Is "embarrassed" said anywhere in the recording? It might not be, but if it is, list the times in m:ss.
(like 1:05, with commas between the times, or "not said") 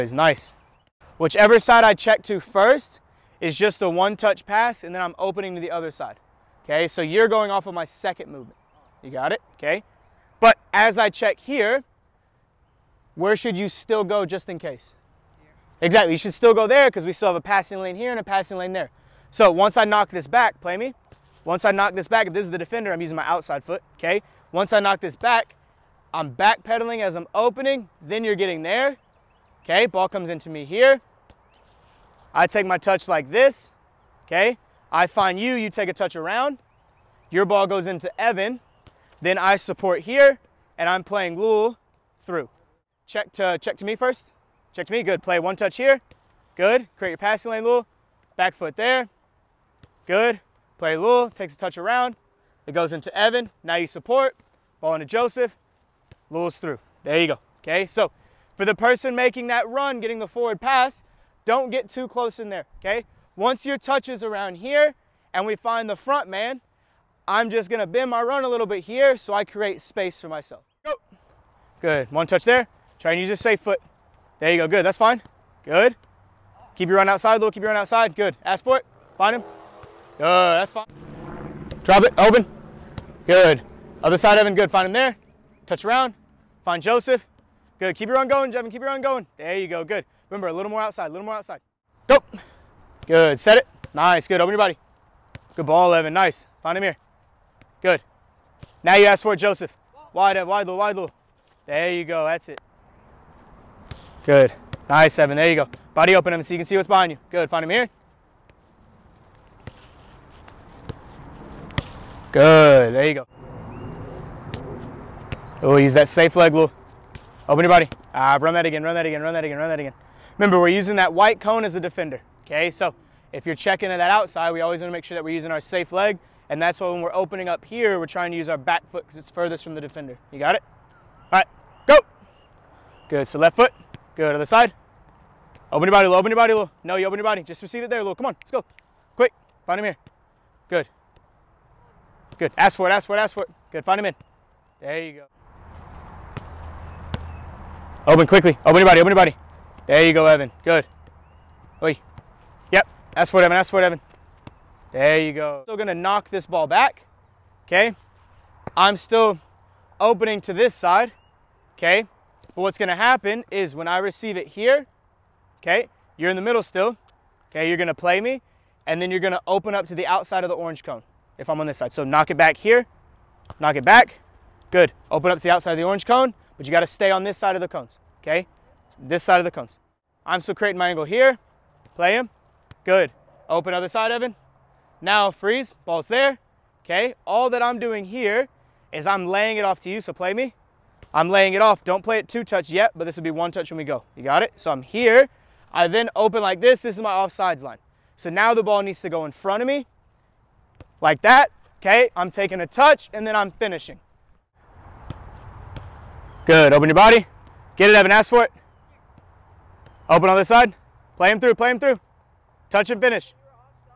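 not said.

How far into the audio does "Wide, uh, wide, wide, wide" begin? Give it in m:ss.
1:40.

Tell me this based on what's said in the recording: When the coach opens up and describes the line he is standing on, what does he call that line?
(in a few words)
Offsides line.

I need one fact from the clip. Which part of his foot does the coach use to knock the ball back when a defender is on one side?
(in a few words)
Outside foot.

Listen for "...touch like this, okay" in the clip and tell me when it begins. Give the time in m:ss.
0:32.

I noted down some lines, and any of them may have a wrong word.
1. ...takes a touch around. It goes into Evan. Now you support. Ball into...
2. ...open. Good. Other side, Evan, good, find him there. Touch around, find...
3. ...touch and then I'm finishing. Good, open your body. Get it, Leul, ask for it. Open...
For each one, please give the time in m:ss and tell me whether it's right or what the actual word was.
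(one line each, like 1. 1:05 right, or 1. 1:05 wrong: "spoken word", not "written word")
1. 0:51 right
2. 1:22 right
3. 3:22 wrong: "Evan", not "Leul".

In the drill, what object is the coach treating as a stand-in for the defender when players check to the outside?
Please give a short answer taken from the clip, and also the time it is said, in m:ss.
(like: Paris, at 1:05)
White cone, at 2:01.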